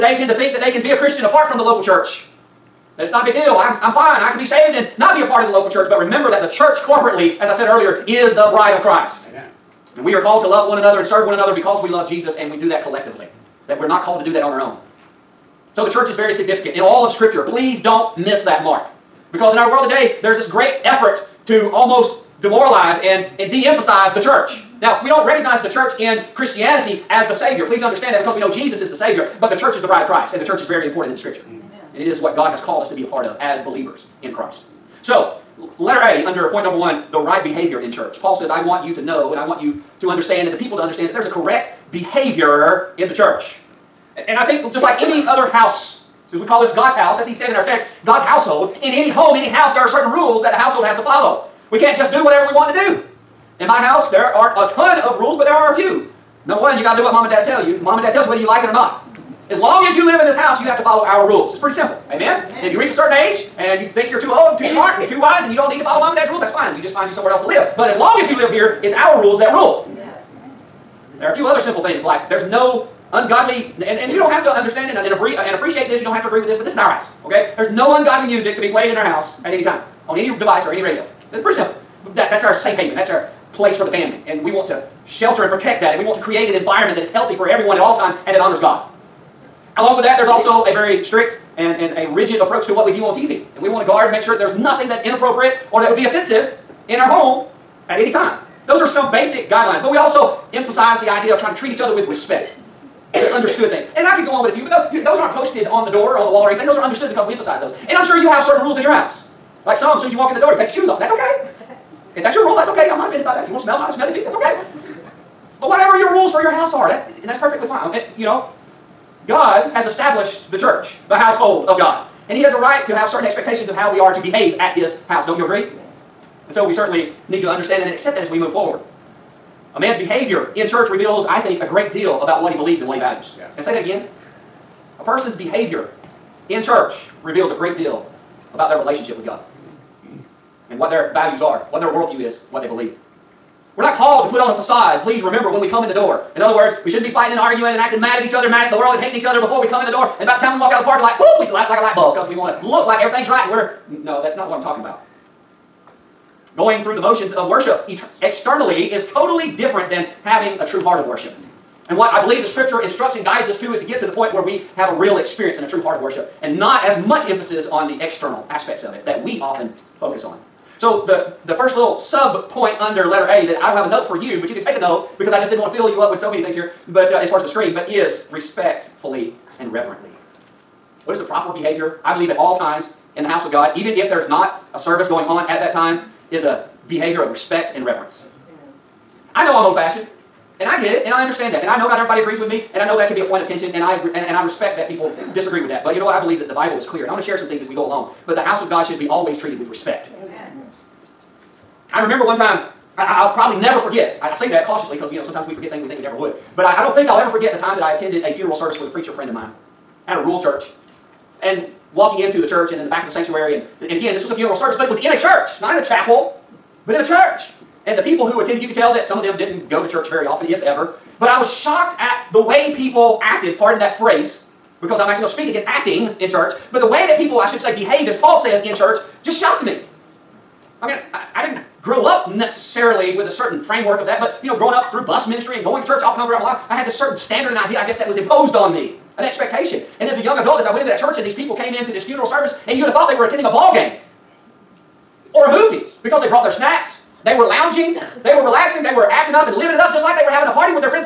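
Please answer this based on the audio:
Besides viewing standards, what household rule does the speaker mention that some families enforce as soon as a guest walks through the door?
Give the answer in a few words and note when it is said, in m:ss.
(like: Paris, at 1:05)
Take your shoes off, at 1:50.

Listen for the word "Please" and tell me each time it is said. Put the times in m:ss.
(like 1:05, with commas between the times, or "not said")
0:17, 0:27, 2:25.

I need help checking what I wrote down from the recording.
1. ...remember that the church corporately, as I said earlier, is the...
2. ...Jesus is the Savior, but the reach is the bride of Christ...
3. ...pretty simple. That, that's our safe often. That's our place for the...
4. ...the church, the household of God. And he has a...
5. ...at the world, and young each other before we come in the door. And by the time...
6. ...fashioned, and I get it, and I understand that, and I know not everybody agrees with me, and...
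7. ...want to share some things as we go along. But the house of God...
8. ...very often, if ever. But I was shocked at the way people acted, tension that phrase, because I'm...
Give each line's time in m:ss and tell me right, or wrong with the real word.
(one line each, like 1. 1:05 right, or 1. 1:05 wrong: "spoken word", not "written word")
1. 0:05 right
2. 0:28 wrong: "church", not "reach"
3. 1:21 wrong: "haven", not "often"
4. 2:00 right
5. 2:28 wrong: "hating", not "young"
6. 3:09 right
7. 3:17 right
8. 3:40 wrong: "pardon", not "tension".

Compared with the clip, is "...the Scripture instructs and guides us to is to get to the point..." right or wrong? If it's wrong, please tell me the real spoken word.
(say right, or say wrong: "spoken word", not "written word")
right.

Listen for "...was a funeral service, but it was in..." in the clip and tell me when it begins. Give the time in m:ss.
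3:34.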